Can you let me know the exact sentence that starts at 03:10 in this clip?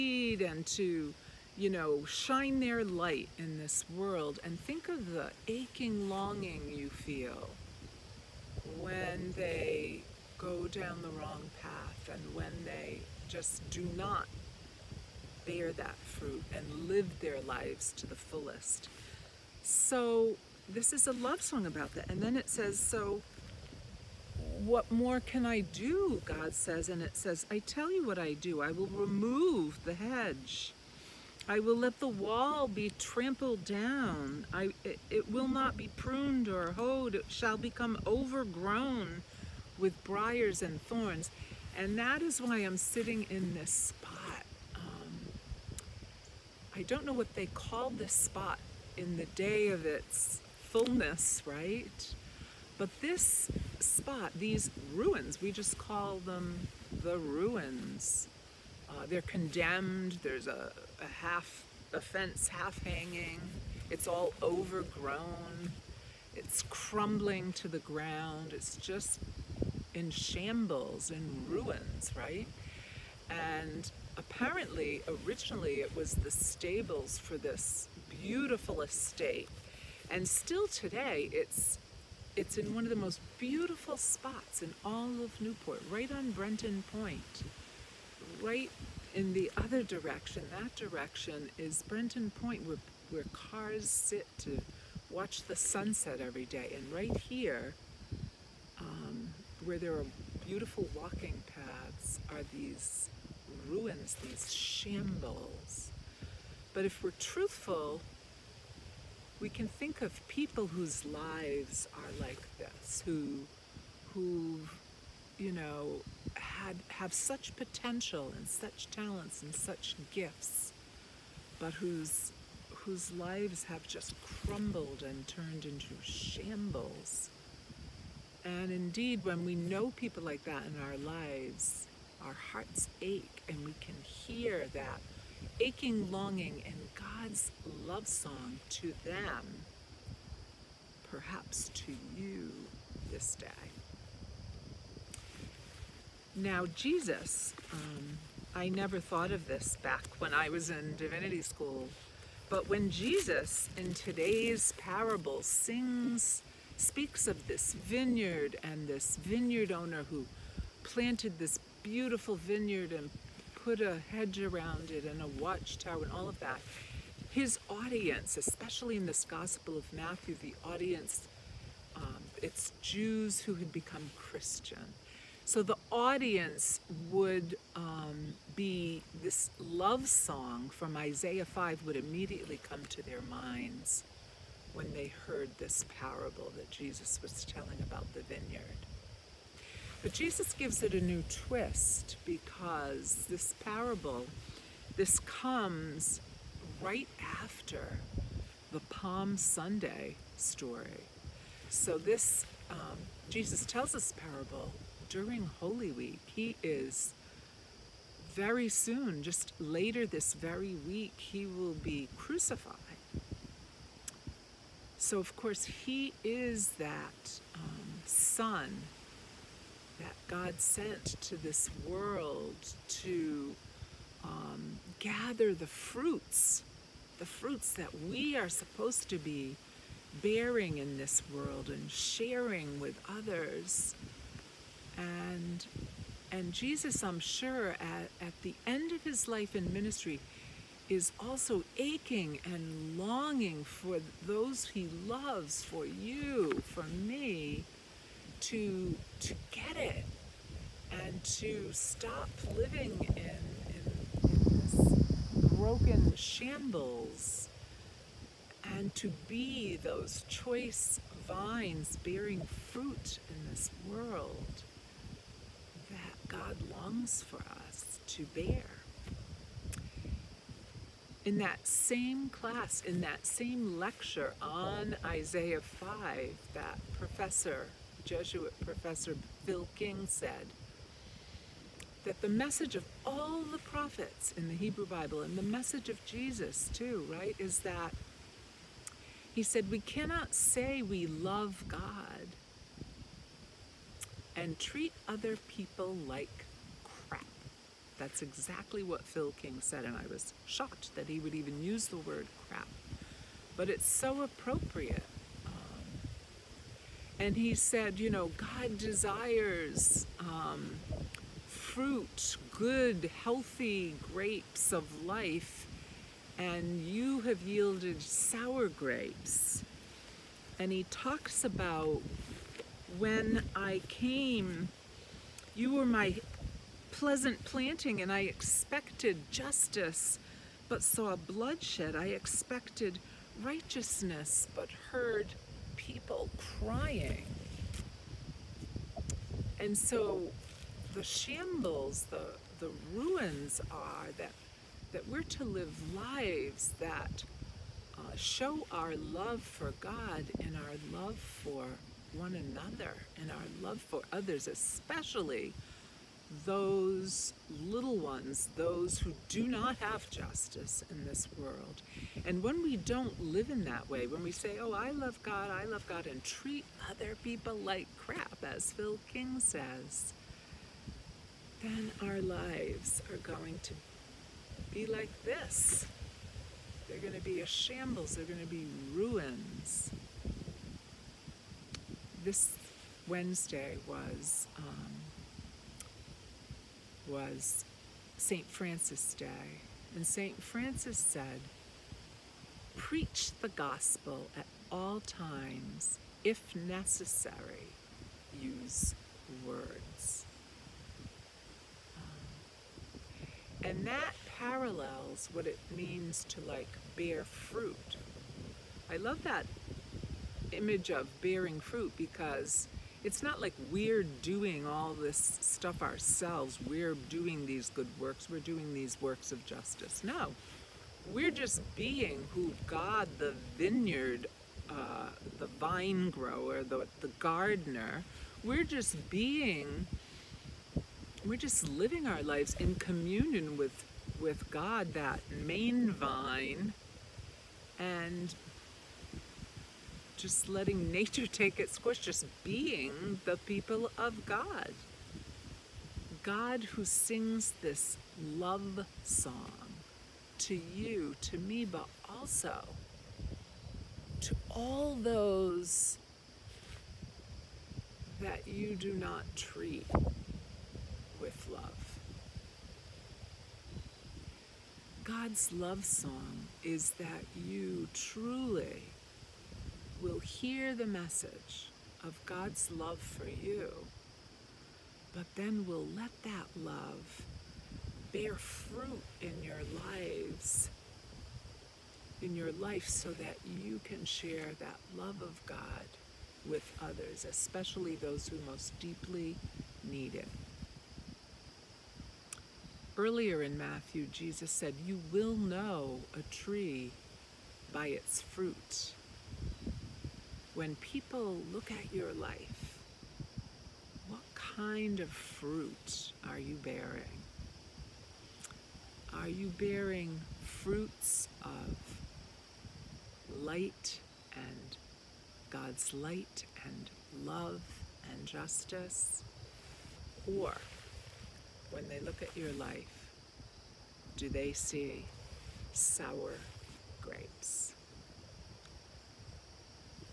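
But Jesus gives it a new twist because this parable, this comes right after the Palm Sunday story.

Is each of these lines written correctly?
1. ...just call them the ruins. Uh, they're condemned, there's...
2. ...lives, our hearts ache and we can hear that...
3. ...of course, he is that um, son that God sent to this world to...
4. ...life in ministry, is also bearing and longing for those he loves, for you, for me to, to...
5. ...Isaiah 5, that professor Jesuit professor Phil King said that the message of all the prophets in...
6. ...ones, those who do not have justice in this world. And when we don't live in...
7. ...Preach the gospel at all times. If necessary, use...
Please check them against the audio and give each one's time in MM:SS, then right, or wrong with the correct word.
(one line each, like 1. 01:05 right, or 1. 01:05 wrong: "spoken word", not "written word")
1. 00:55 right
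2. 02:10 right
3. 03:35 right
4. 03:59 wrong: "aching", not "bearing"
5. 04:35 right
6. 05:57 right
7. 06:32 right.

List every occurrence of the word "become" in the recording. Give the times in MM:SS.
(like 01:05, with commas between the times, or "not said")
00:37, 02:53.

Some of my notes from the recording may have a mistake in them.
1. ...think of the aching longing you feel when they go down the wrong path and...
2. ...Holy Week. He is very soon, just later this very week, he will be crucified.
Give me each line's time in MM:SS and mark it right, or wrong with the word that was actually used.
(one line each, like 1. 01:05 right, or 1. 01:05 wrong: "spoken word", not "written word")
1. 00:04 right
2. 03:25 right.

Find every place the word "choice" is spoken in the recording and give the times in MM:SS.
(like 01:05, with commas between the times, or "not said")
04:20.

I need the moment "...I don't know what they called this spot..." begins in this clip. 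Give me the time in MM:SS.
00:46.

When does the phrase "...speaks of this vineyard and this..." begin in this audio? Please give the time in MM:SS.
02:36.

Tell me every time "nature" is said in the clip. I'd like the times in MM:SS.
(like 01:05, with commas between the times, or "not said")
07:20.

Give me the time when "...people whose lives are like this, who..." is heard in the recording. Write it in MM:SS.
01:50.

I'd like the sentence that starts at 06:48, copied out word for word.
I love that image of bearing fruit because it's not like we're doing all this stuff ourselves.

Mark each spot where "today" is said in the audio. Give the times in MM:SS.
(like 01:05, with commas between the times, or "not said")
01:20, 02:33.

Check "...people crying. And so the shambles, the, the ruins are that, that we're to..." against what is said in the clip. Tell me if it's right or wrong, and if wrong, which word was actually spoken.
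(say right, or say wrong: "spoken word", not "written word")
right.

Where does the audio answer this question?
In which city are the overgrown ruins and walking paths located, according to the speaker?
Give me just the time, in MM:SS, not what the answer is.
01:25.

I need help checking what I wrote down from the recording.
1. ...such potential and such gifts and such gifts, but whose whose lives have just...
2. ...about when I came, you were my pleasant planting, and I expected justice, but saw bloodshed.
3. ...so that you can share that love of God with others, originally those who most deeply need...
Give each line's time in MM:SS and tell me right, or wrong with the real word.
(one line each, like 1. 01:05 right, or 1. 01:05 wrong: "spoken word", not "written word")
1. 01:57 wrong: "talents", not "gifts"
2. 05:21 right
3. 08:02 wrong: "especially", not "originally".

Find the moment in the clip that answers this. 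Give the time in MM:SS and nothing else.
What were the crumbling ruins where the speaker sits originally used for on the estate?
01:16.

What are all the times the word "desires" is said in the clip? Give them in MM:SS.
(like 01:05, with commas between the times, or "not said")
05:08.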